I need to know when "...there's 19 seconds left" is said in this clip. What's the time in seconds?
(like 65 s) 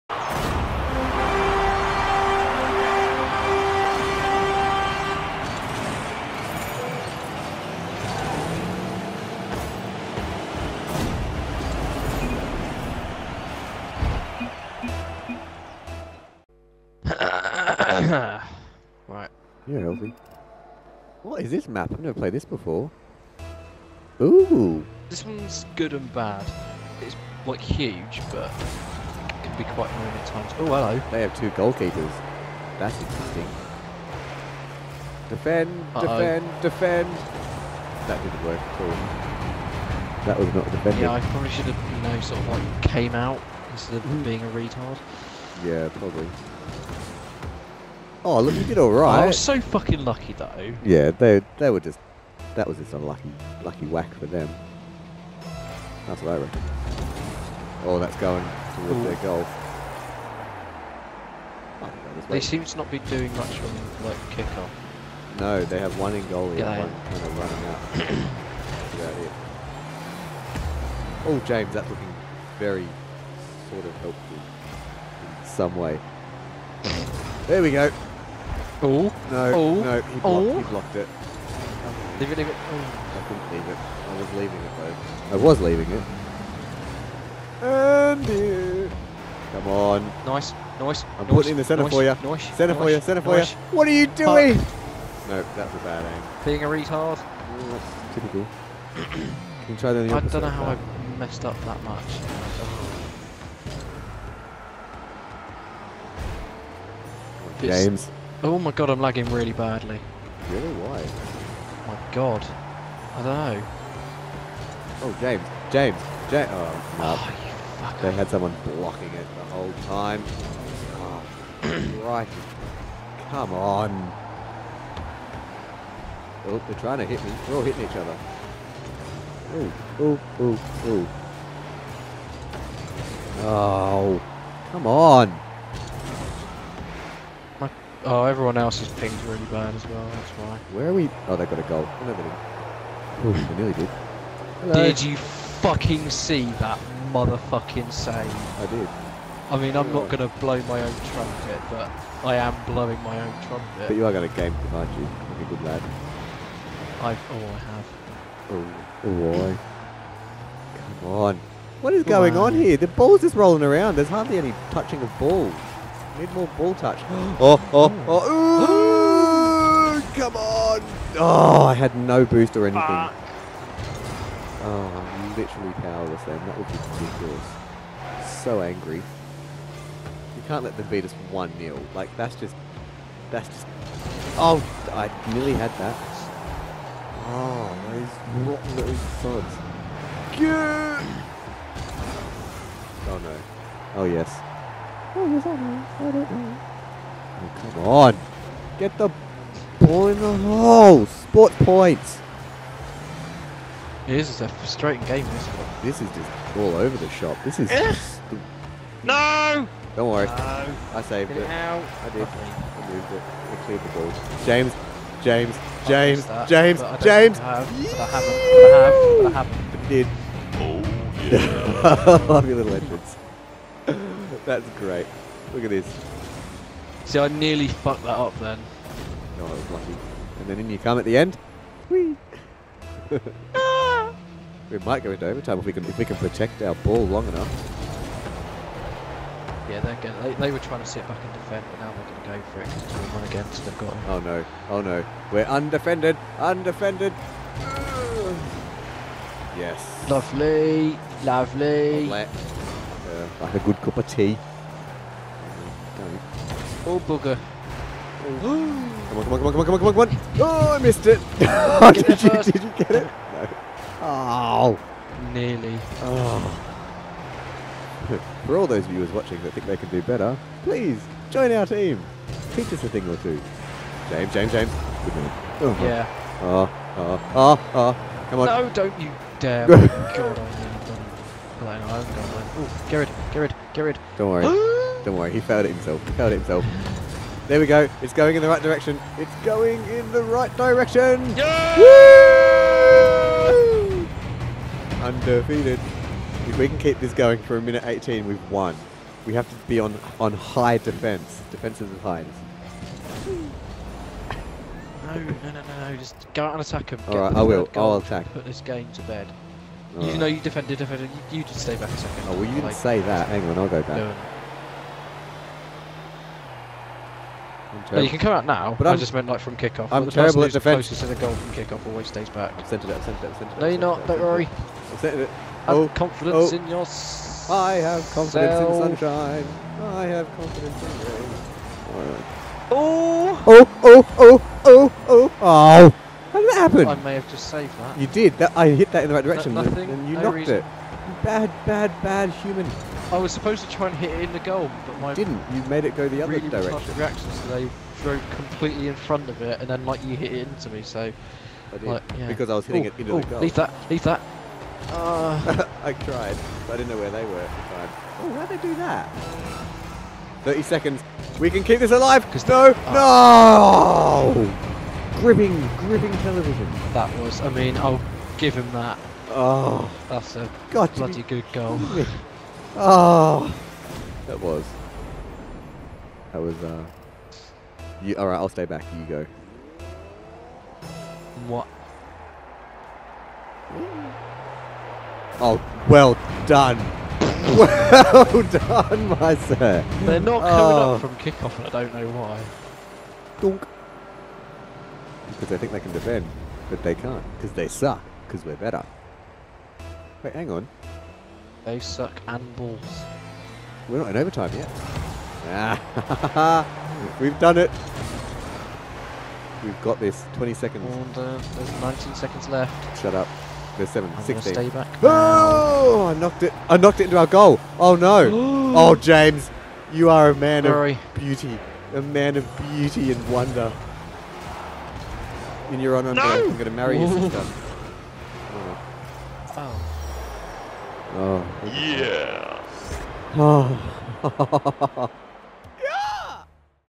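411 s.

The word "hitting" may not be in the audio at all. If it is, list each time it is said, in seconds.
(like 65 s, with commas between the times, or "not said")
127 s, 352 s.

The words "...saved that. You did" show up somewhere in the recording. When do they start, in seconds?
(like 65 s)
337 s.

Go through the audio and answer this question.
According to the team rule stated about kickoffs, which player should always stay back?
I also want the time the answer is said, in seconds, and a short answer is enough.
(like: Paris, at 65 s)
Closest to the goal, at 320 s.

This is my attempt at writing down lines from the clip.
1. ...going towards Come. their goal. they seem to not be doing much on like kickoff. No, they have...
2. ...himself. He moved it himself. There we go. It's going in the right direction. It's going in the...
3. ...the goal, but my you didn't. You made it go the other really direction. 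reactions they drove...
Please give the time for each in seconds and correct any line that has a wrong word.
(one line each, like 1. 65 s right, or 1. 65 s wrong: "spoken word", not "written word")
1. 58 s wrong: "Ooh", not "Come"
2. 285 s wrong: "failed", not "moved"
3. 344 s right.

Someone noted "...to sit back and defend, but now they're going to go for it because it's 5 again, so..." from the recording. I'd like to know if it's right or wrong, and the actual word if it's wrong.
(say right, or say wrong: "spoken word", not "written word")
wrong: "1", not "5".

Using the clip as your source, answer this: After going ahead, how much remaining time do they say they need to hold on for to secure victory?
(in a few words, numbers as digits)
1 minute 18.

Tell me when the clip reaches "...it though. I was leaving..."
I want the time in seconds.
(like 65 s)
84 s.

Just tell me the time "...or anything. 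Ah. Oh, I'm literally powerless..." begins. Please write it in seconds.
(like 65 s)
172 s.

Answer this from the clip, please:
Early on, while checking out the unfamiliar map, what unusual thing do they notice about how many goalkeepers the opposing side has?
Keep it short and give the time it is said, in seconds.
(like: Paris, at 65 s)
2, at 31 s.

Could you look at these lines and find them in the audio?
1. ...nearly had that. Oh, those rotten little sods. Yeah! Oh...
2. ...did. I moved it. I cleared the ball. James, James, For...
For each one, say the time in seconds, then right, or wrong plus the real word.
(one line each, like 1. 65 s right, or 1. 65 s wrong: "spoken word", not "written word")
1. 185 s right
2. 212 s wrong: "James", not "For".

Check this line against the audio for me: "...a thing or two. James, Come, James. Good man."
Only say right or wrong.
wrong.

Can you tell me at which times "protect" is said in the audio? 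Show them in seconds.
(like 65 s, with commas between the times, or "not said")
236 s.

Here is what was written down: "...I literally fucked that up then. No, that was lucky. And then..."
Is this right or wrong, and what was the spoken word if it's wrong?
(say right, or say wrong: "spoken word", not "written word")
wrong: "nearly", not "literally".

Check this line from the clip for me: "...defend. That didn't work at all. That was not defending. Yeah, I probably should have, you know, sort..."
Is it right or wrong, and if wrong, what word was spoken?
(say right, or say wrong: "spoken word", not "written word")
right.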